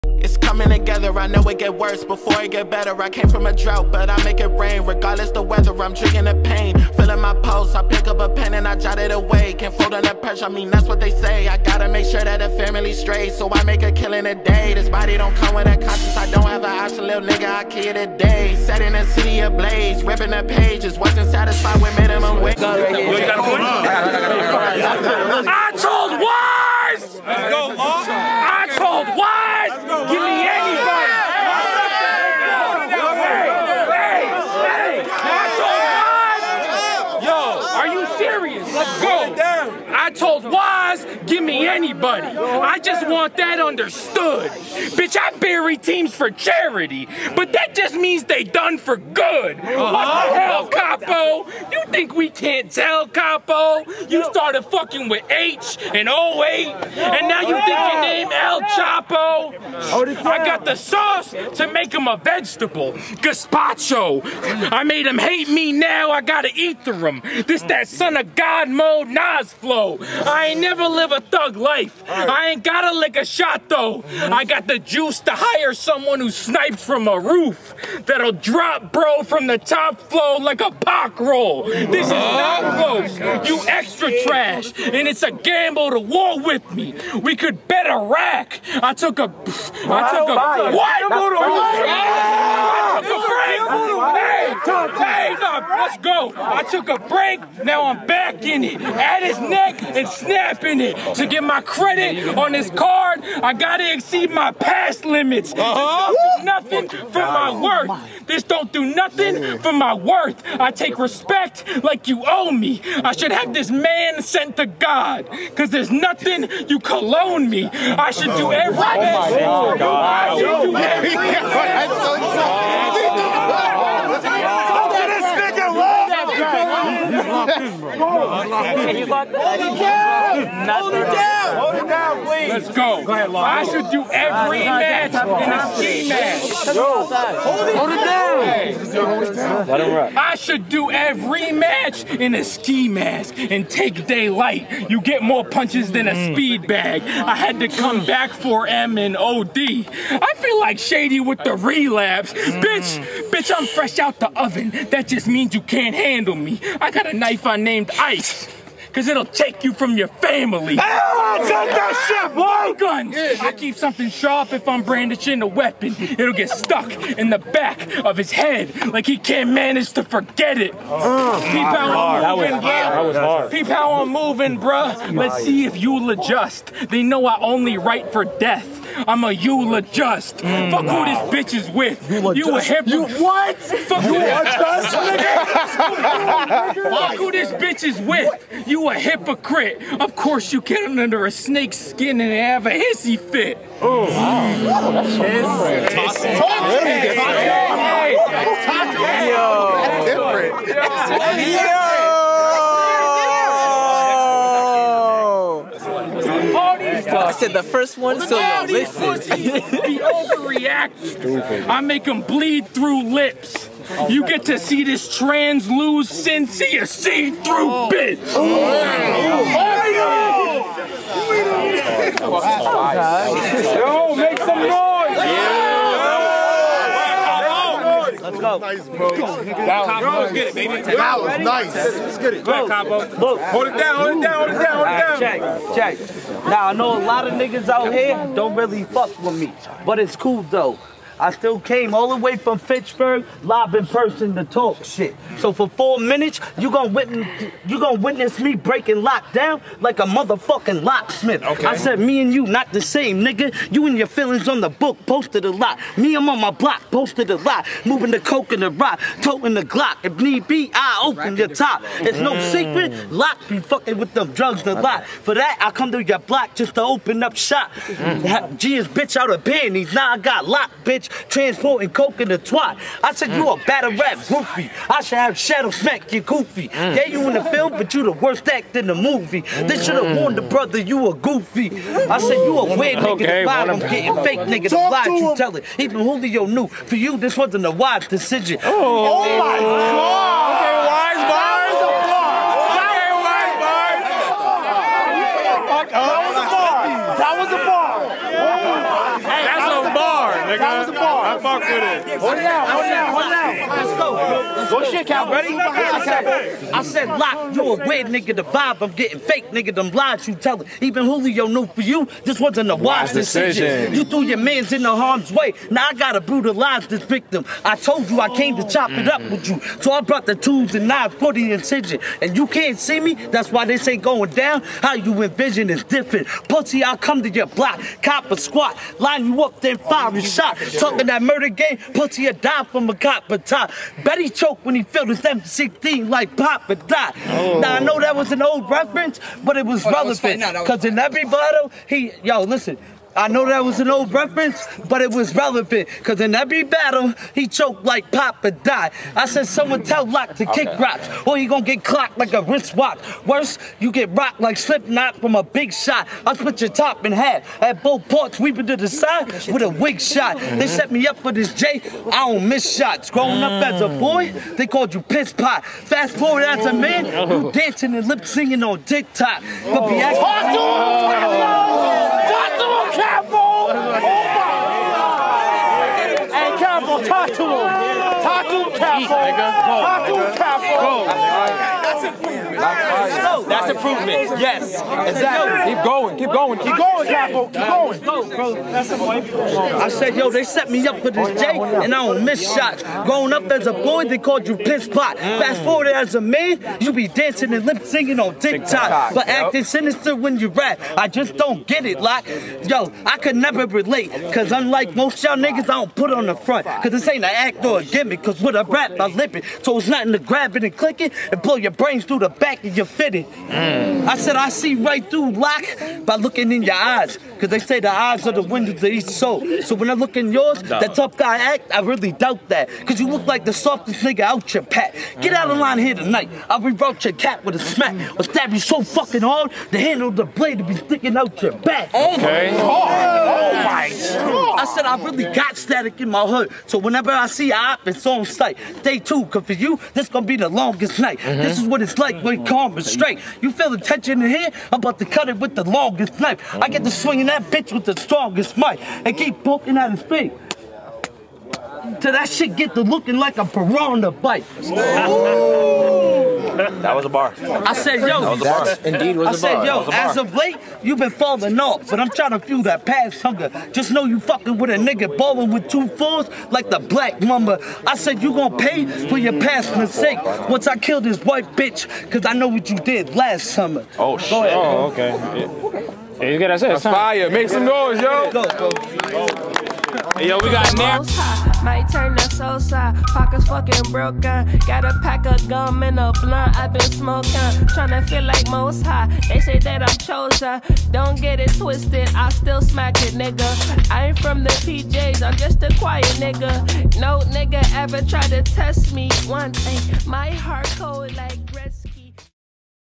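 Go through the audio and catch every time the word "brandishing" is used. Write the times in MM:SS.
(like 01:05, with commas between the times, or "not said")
02:44.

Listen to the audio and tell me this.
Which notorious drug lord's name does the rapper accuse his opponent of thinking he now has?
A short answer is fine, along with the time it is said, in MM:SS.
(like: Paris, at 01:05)
El Chapo, at 00:58.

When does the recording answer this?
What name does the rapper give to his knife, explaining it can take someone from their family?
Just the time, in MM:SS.
02:37.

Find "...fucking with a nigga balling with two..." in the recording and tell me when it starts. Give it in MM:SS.
07:44.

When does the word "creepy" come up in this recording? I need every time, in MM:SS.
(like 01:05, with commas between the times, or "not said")
not said.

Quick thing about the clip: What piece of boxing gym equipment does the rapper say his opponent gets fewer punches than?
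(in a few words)
speed bag.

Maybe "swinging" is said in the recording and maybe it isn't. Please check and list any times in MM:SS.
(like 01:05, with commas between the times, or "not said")
07:26.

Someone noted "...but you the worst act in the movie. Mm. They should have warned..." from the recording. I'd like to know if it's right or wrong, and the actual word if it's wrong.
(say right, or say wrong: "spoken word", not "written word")
right.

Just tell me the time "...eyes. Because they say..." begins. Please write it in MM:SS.
06:56.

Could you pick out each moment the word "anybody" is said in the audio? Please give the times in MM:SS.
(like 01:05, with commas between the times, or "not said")
00:41.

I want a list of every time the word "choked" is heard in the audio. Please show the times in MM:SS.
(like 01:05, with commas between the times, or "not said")
05:34, 05:47.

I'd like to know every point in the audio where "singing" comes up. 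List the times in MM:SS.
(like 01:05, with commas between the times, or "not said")
06:08, 06:37.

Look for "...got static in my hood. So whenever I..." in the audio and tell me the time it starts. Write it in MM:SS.
07:15.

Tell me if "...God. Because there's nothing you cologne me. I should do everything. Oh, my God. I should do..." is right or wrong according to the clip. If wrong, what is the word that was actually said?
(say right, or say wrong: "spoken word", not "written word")
right.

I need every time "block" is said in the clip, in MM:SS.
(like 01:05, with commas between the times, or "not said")
04:16, 04:26, 05:27.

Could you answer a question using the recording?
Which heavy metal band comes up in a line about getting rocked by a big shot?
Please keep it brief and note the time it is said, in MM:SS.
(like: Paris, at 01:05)
Slipknot, at 05:54.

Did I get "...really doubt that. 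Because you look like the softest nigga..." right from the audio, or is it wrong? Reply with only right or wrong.
right.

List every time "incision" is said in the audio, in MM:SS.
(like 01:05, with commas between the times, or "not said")
05:21.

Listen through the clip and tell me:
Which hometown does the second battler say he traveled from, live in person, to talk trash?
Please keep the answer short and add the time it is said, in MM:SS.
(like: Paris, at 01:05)
Fitchburg, at 04:02.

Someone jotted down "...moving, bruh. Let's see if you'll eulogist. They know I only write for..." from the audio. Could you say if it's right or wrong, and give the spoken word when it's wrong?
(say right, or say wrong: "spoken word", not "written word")
wrong: "adjust", not "eulogist".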